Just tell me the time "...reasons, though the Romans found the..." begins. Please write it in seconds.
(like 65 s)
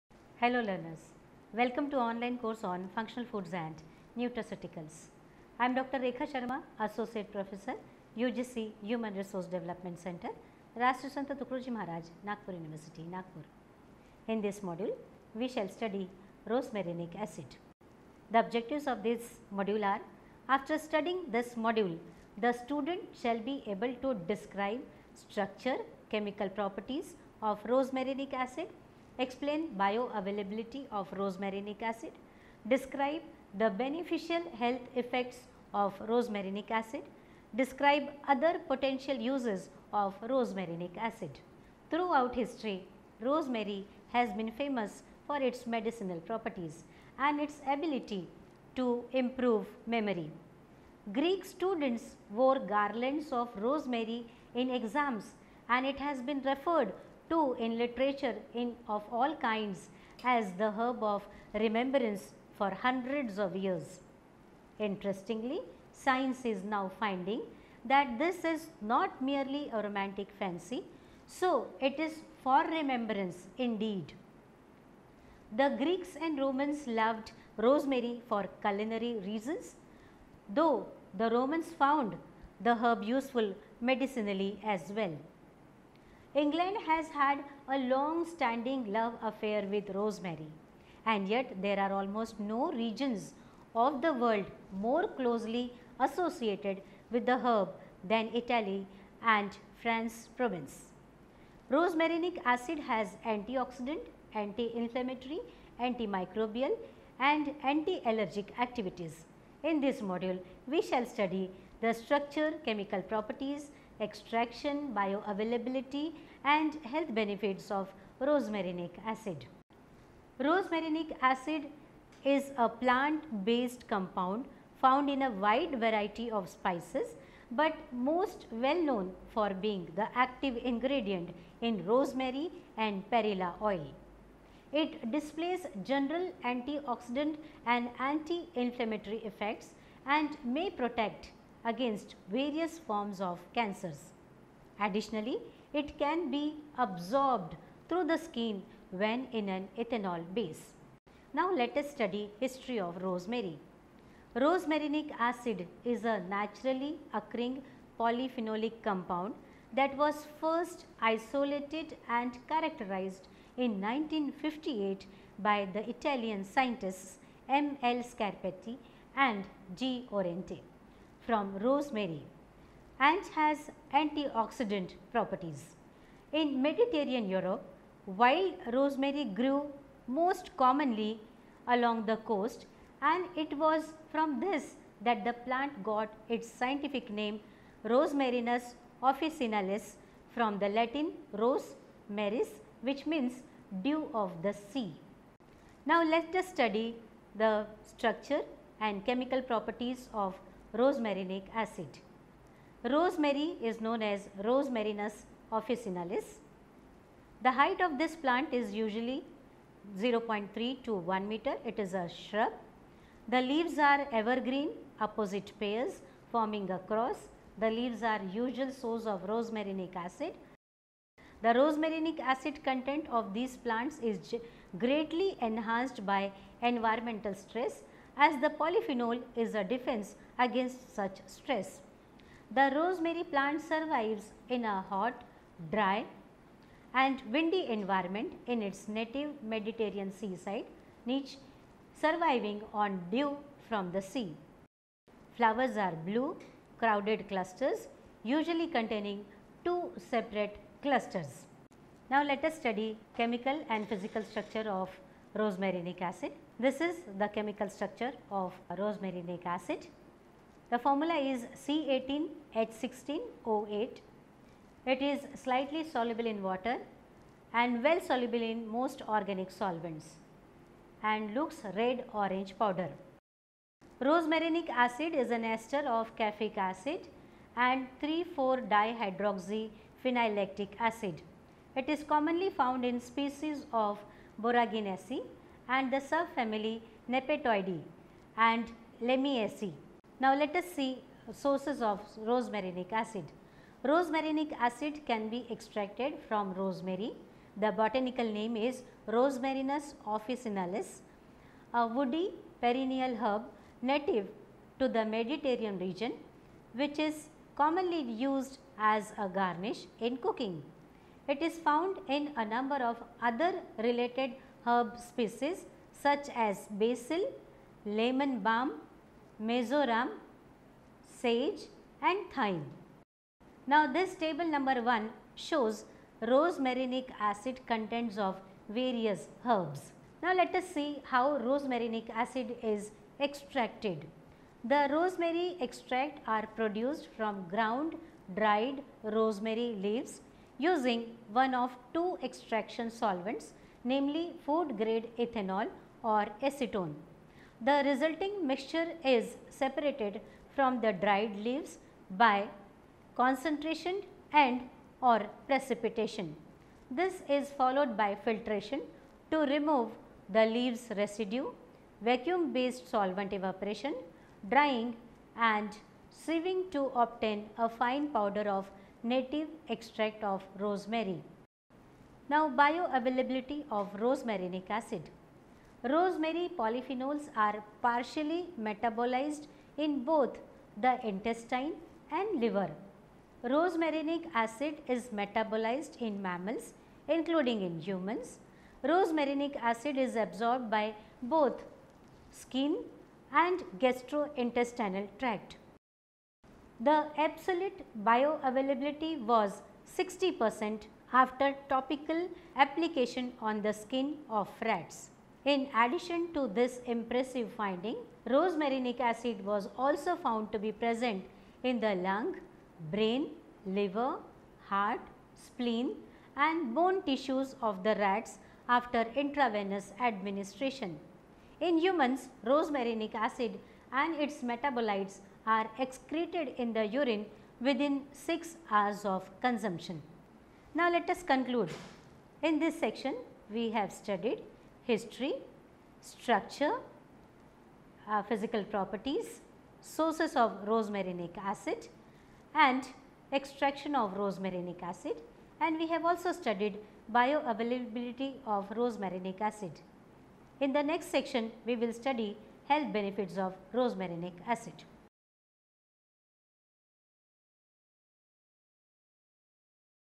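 79 s.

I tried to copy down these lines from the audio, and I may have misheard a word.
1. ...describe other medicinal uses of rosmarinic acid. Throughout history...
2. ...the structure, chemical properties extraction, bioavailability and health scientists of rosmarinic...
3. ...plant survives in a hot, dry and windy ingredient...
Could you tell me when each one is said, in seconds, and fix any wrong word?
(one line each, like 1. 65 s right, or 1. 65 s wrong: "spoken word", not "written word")
1. 37 s wrong: "potential", not "medicinal"
2. 111 s wrong: "benefits", not "scientists"
3. 233 s wrong: "environment", not "ingredient".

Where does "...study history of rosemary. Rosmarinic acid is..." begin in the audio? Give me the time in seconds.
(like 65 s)
151 s.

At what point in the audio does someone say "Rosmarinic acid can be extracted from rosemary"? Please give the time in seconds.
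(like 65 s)
293 s.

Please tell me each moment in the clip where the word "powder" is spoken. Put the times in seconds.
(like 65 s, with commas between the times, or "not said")
272 s, 368 s.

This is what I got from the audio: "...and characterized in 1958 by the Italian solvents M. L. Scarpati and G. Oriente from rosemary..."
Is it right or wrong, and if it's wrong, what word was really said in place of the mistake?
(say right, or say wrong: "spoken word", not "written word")
wrong: "scientists", not "solvents".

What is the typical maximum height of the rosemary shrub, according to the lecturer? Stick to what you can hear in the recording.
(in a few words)
1 meter.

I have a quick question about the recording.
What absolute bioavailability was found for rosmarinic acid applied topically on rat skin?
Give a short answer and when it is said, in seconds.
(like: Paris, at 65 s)
60 percent, at 399 s.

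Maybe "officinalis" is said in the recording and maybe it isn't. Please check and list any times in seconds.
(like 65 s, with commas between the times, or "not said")
189 s, 205 s, 300 s.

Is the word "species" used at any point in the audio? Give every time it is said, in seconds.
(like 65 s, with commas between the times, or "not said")
283 s, 314 s.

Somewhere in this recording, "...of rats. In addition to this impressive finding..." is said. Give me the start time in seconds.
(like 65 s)
404 s.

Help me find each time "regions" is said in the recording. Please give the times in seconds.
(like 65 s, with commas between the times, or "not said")
92 s, 305 s.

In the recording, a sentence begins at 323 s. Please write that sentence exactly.
Now this table number 1 shows rosmarinic acid contents of various herbs.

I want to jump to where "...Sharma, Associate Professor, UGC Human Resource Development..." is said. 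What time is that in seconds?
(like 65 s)
6 s.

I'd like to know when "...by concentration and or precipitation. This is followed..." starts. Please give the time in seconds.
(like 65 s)
352 s.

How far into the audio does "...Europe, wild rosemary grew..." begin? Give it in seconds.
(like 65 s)
177 s.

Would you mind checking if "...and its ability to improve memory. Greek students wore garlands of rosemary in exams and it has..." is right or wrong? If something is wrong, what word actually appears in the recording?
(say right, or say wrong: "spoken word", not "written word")
right.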